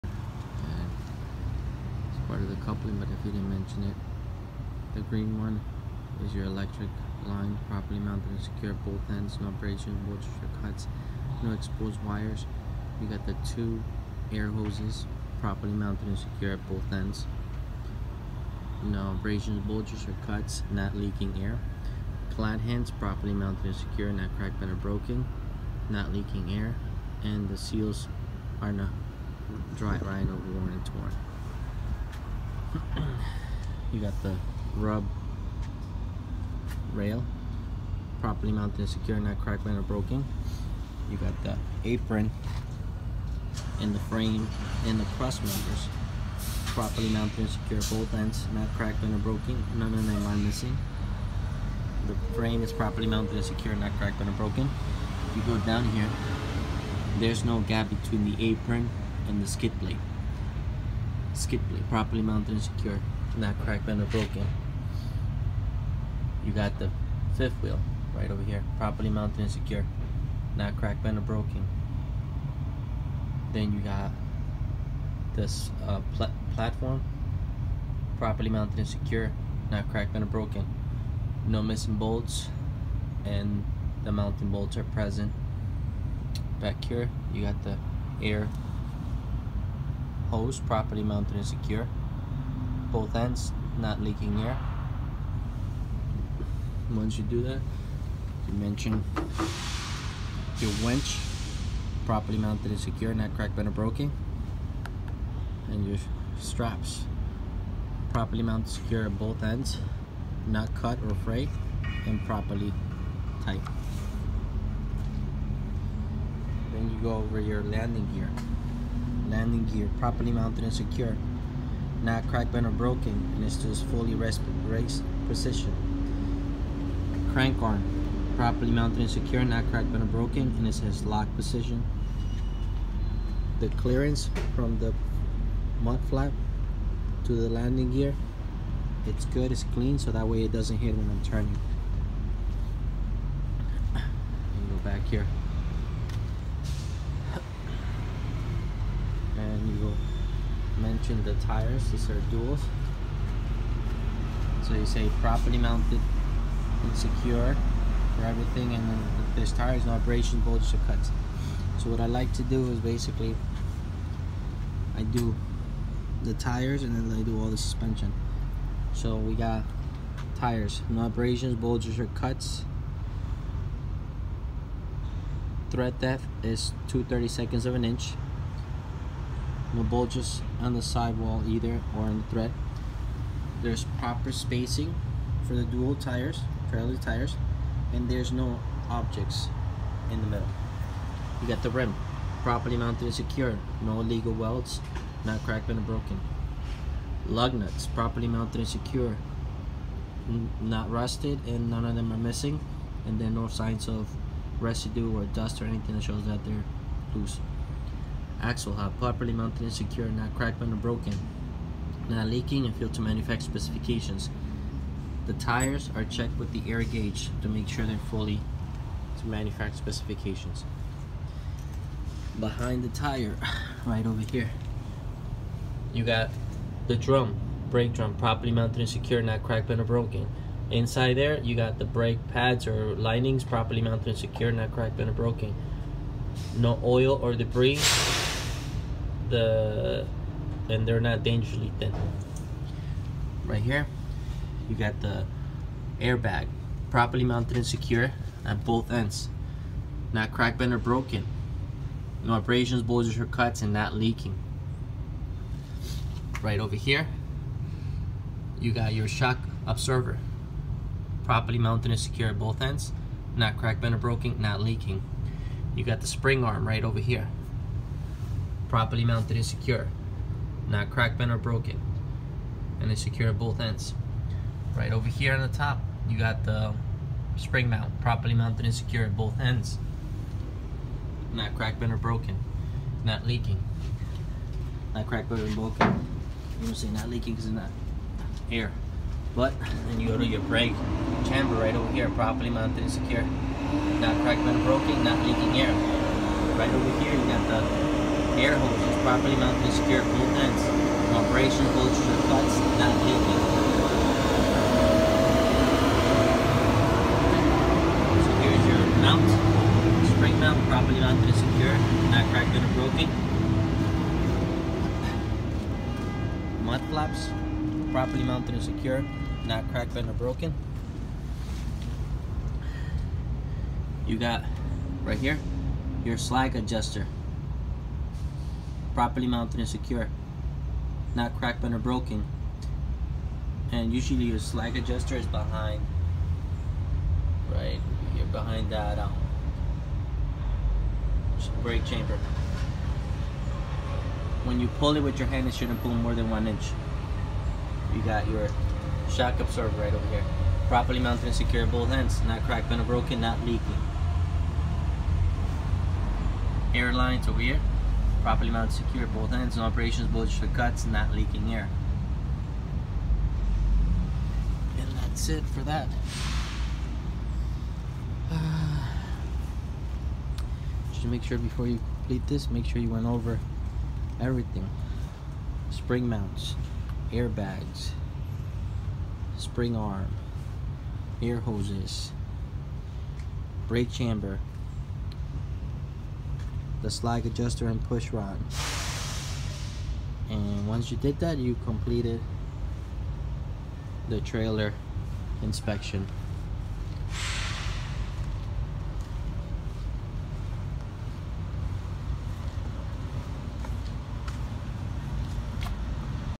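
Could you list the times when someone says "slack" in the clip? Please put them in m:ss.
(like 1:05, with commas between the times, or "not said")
5:26, 5:34.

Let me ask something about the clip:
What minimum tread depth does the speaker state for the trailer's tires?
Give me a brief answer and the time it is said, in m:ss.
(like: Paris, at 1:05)
2/32 of an inch, at 2:56.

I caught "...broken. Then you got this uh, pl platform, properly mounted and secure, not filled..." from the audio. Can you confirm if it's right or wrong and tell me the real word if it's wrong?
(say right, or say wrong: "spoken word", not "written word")
wrong: "cracked", not "filled".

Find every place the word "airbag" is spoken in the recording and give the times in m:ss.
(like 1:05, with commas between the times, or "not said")
4:05, 6:17.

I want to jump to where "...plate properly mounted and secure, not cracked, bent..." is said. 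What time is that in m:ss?
1:01.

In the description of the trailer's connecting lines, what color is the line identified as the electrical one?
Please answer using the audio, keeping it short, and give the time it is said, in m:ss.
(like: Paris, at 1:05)
Green, at 0:05.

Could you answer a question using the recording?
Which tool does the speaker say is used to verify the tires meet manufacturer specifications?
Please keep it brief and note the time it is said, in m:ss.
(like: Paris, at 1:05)
Air gauge, at 3:36.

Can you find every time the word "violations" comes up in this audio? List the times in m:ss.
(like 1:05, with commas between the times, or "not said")
not said.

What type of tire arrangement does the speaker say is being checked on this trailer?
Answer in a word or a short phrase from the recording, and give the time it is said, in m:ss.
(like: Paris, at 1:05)
Duals, at 2:32.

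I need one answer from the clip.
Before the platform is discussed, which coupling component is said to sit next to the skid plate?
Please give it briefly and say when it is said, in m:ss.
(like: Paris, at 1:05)
Fifth wheel, at 1:07.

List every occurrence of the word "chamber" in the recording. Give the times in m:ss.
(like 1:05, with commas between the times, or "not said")
4:51, 5:41, 6:23.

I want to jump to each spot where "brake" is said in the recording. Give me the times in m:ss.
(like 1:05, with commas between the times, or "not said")
3:47, 3:51, 4:50, 5:41, 6:23.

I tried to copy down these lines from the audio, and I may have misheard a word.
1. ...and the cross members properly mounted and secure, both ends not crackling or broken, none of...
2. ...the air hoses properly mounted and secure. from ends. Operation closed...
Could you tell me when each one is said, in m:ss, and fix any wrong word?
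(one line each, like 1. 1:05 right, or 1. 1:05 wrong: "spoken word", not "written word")
1. 0:44 right
2. 4:57 right.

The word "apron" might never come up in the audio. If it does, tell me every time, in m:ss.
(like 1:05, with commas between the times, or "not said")
0:41, 0:58.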